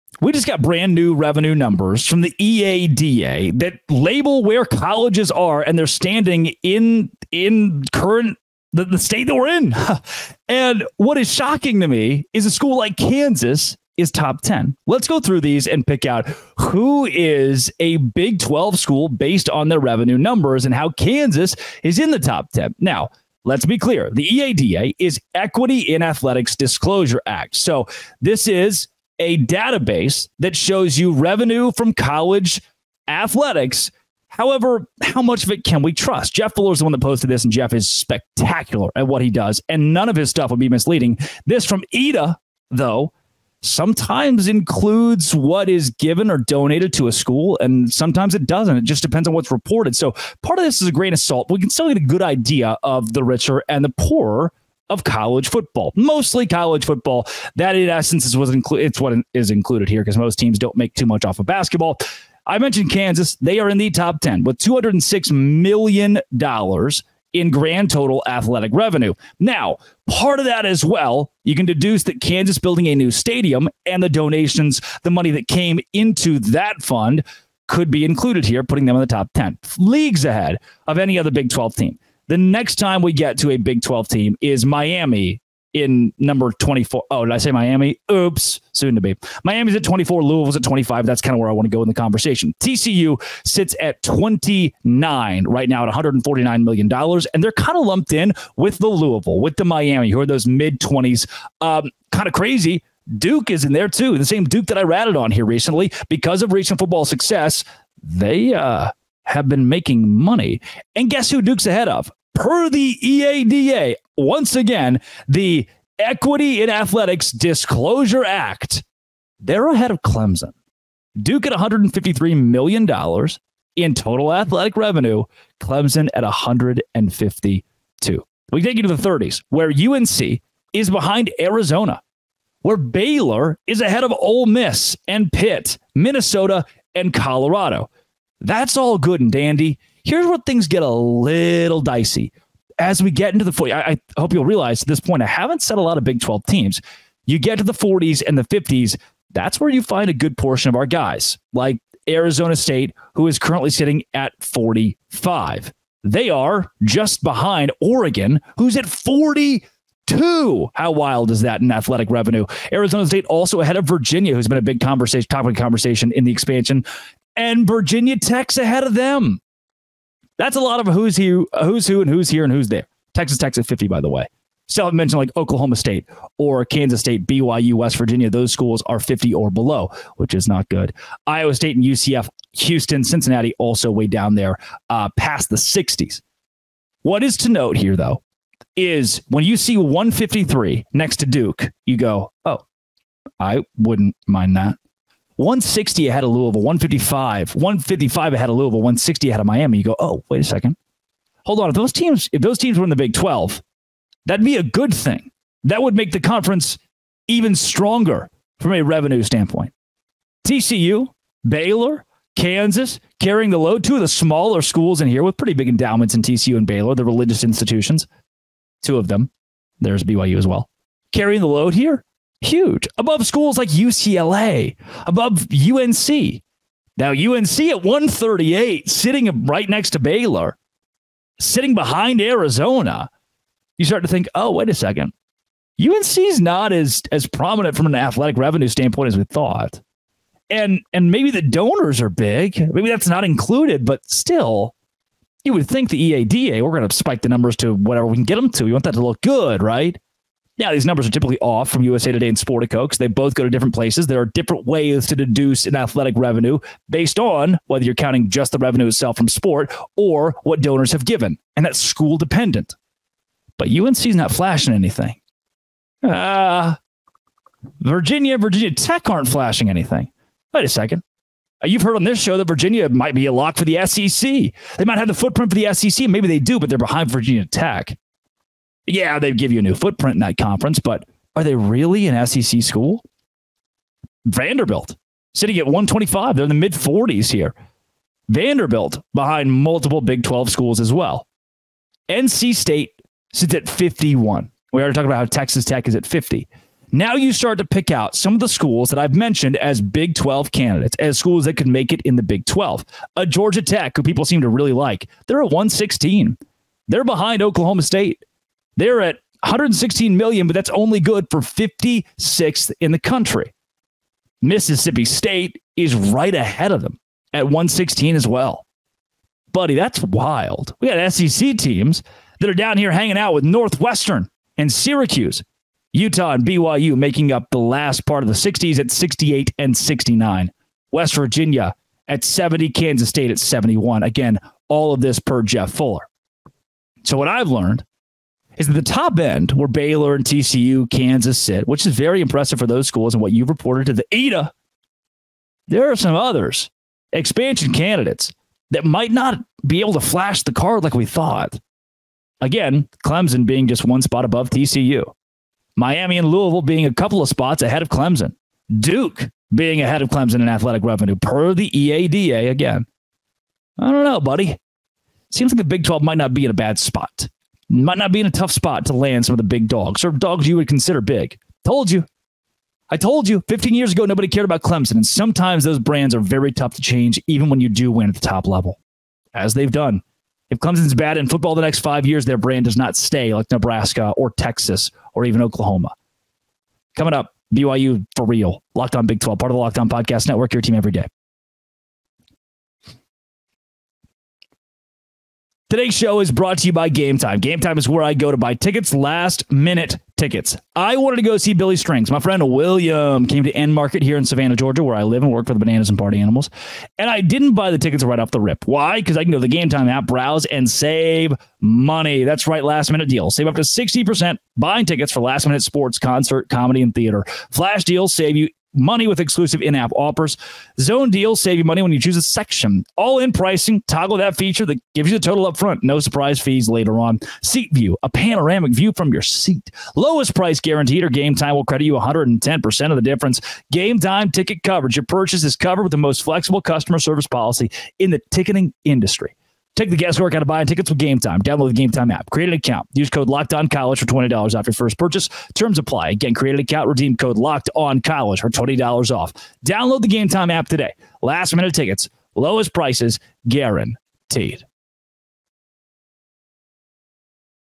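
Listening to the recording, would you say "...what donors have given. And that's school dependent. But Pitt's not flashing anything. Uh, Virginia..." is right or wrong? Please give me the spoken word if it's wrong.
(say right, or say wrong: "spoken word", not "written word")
wrong: "UNC", not "Pitt".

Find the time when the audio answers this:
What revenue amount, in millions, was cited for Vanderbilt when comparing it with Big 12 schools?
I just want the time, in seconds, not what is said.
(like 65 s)
285 s.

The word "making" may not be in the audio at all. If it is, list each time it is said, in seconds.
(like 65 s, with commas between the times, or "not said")
109 s, 326 s.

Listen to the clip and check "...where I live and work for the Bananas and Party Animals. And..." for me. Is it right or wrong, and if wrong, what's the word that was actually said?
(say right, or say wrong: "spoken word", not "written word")
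right.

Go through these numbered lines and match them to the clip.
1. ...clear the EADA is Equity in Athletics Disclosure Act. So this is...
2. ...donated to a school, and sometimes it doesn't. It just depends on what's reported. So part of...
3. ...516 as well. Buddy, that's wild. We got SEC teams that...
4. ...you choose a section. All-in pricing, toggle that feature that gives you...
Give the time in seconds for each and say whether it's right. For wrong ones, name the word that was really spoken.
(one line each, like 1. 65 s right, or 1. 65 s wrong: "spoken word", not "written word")
1. 23 s right
2. 46 s right
3. 317 s wrong: "116", not "516"
4. 421 s right.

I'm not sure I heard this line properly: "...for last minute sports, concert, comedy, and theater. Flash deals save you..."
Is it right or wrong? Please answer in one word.
right.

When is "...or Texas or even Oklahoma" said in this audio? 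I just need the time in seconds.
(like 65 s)
384 s.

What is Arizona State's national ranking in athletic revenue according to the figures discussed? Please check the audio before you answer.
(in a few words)
45.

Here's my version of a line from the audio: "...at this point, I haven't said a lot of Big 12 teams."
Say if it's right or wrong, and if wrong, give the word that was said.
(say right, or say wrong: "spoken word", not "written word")
right.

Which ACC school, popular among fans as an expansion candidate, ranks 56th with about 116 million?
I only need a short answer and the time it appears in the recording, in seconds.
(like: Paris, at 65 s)
Georgia Tech, at 303 s.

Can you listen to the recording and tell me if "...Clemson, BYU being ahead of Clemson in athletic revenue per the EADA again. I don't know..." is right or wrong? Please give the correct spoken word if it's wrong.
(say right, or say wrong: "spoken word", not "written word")
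wrong: "Duke", not "BYU".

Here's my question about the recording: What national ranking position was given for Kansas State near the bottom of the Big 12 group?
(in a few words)
71.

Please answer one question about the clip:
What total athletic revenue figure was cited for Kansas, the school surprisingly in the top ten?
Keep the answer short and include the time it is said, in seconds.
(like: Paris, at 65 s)
$206 million, at 64 s.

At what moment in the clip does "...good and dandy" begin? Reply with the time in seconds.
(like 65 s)
138 s.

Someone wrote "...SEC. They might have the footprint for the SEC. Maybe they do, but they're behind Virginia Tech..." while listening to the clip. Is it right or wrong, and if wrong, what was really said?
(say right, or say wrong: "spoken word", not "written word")
right.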